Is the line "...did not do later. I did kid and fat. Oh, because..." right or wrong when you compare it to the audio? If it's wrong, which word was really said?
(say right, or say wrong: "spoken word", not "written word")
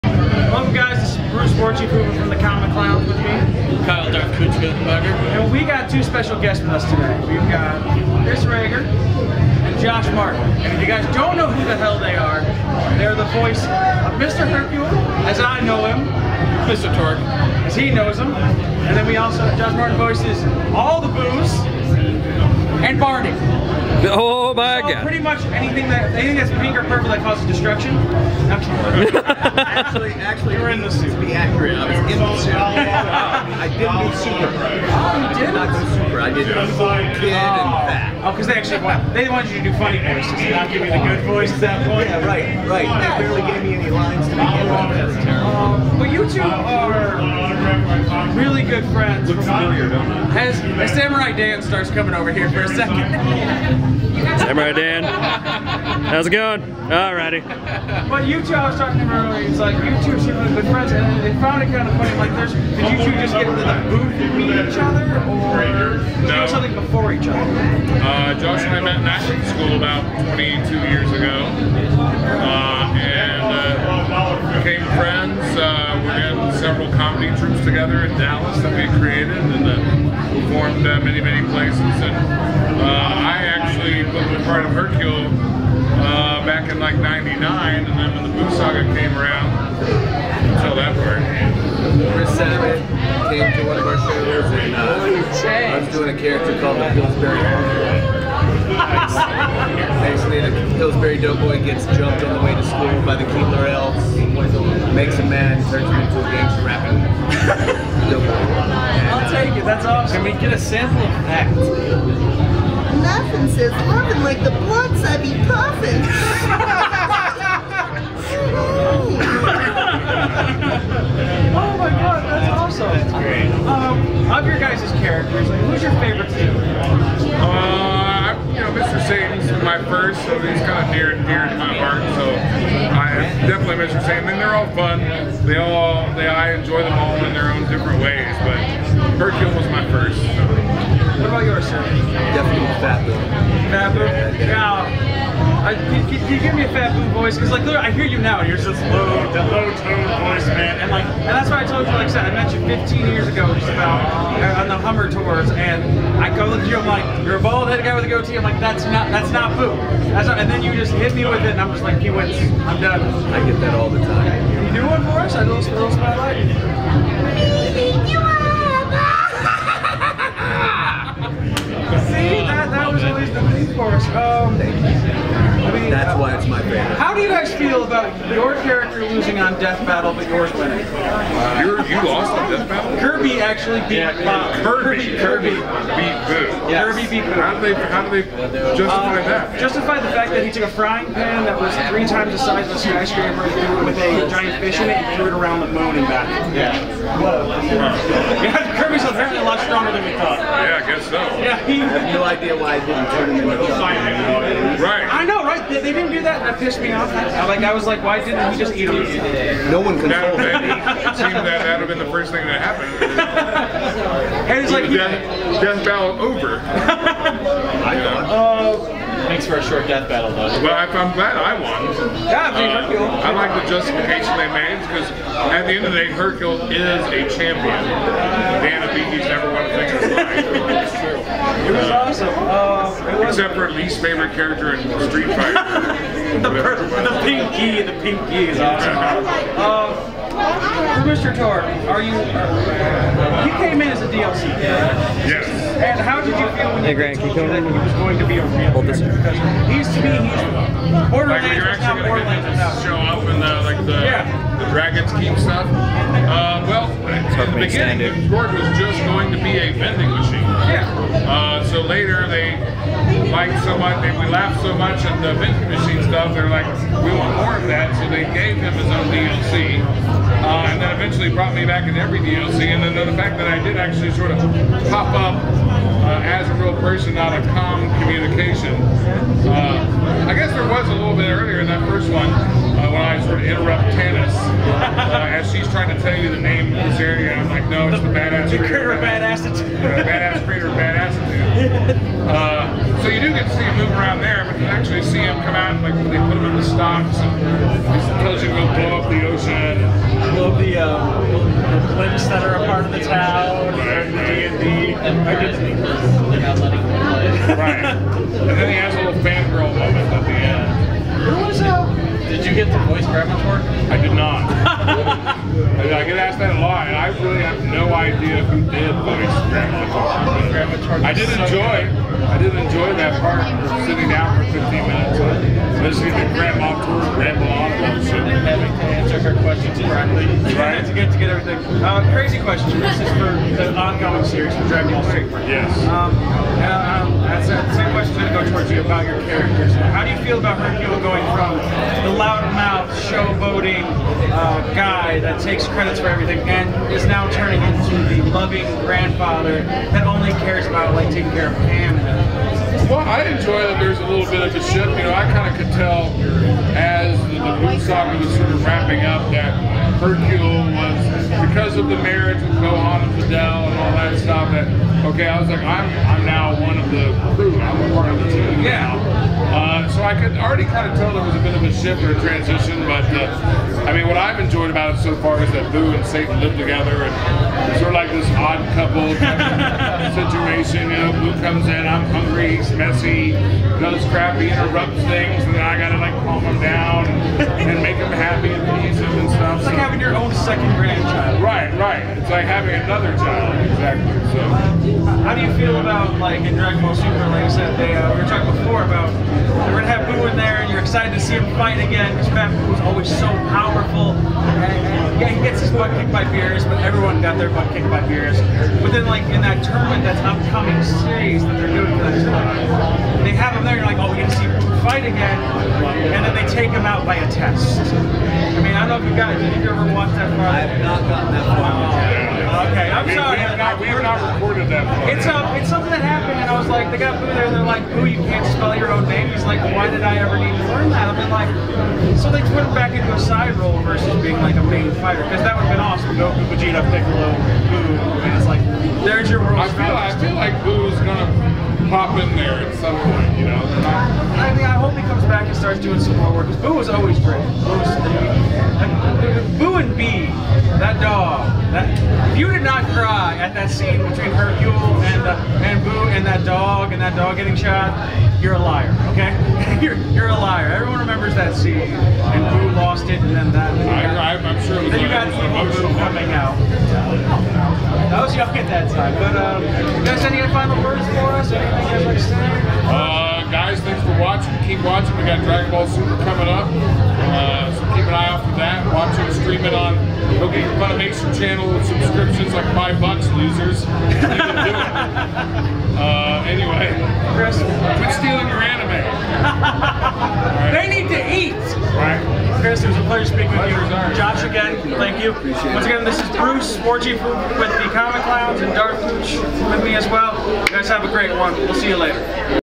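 wrong: "super", not "later".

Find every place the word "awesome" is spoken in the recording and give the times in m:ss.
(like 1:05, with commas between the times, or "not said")
1:49, 2:02, 3:51, 3:58, 7:15.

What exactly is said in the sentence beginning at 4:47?
I'm like, no, it's the, the badass the crater.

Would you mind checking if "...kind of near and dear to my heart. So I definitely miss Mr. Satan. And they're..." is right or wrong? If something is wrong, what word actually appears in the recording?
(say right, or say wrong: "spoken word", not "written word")
right.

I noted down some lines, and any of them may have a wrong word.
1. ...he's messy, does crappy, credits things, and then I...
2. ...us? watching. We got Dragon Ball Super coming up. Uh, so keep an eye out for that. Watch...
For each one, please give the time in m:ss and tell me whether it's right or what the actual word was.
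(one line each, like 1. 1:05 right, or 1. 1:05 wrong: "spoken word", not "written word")
1. 6:22 wrong: "interrupts", not "credits"
2. 7:51 right.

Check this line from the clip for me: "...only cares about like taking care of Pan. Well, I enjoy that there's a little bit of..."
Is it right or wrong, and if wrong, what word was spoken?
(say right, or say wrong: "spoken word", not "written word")
right.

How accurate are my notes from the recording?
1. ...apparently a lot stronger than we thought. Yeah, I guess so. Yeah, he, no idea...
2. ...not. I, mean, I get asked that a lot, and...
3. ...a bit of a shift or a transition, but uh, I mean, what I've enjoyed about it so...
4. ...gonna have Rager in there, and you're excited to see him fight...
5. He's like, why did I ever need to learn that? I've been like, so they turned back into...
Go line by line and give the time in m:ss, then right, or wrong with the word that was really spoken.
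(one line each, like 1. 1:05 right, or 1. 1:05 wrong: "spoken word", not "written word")
1. 3:19 right
2. 5:14 right
3. 6:11 right
4. 6:39 wrong: "Buu", not "Rager"
5. 7:09 right.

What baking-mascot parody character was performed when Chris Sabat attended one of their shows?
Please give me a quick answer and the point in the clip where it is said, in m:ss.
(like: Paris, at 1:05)
Pillsbury Uncle, at 1:36.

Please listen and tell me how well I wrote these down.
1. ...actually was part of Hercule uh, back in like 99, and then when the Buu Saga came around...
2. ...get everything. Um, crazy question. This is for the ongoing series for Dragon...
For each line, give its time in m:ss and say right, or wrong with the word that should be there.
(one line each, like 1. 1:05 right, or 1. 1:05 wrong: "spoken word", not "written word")
1. 1:23 right
2. 5:31 right.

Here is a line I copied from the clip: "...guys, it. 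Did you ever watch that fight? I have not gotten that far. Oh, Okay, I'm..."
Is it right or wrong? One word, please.
right.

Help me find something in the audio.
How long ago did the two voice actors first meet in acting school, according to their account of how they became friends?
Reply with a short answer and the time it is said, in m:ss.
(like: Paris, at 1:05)
22 years, at 1:10.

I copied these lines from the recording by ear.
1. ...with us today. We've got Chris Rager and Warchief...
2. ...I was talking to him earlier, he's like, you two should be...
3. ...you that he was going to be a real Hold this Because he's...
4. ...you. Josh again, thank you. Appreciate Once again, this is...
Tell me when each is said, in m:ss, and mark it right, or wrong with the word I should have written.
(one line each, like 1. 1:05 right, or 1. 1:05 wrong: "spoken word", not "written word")
1. 0:06 wrong: "Josh", not "Warchief"
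2. 0:58 right
3. 4:07 right
4. 8:13 right.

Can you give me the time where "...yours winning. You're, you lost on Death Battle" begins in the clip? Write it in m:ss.
3:00.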